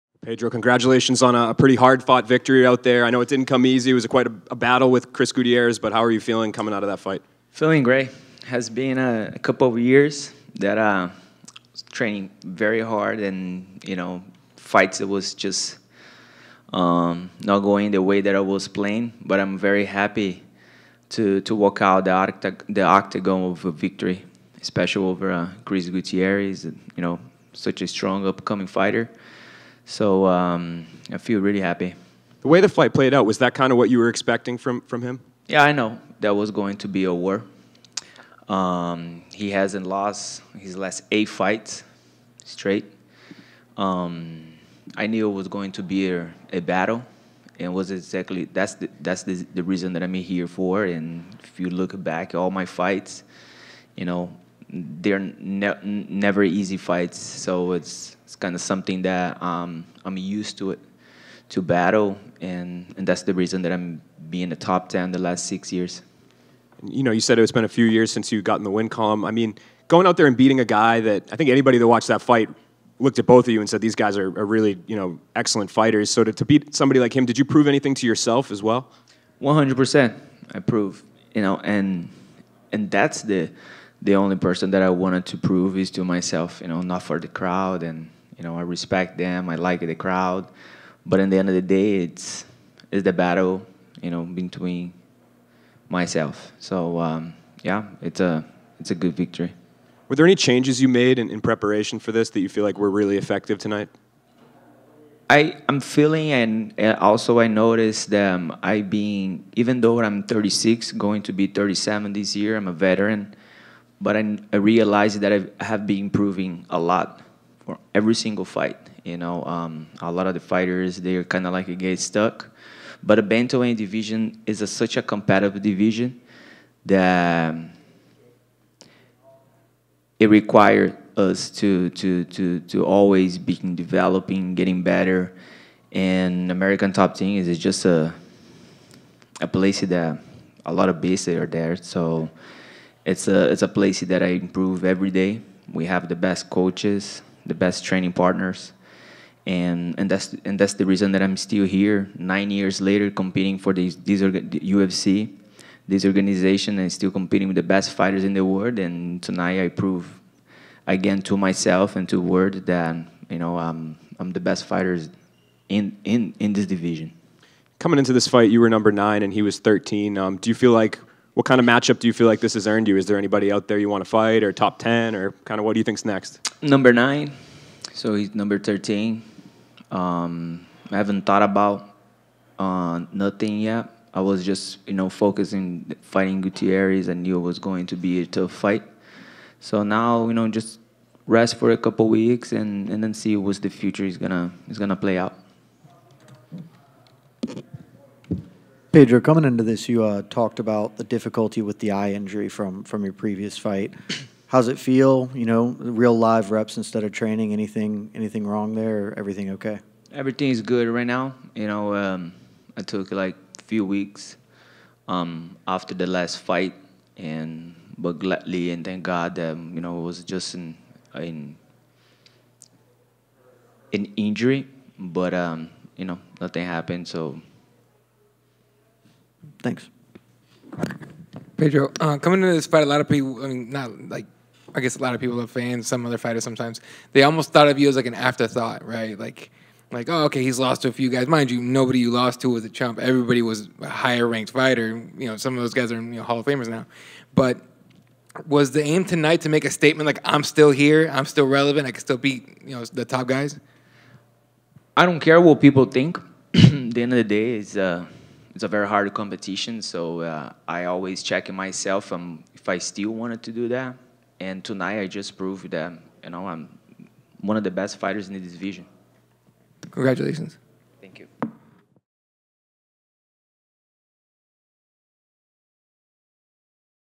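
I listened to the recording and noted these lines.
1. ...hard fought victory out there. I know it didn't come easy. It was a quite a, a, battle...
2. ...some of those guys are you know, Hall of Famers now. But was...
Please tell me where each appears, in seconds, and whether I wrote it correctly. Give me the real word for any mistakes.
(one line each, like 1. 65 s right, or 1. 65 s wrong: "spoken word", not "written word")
1. 1 s right
2. 245 s right.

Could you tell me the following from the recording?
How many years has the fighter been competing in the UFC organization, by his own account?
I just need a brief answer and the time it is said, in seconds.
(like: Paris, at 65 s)
9, at 152 s.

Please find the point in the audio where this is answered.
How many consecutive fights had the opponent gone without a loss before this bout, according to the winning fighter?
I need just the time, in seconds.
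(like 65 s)
41 s.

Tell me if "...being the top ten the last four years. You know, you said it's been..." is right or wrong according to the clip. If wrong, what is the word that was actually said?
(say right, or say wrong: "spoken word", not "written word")
wrong: "six", not "four".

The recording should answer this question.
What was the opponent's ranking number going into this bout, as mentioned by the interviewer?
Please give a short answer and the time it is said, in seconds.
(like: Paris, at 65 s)
13, at 169 s.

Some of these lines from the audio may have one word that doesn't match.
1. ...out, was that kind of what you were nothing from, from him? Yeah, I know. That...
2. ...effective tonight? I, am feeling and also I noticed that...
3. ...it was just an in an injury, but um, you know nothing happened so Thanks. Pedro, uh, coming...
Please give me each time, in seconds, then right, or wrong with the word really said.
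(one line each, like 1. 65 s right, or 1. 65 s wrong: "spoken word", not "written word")
1. 33 s wrong: "expecting", not "nothing"
2. 103 s right
3. 219 s right.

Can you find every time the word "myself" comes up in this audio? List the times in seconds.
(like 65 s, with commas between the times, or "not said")
86 s, 95 s, 161 s, 261 s.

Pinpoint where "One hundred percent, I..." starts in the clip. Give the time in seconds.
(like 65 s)
79 s.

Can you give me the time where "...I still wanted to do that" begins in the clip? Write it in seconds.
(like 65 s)
262 s.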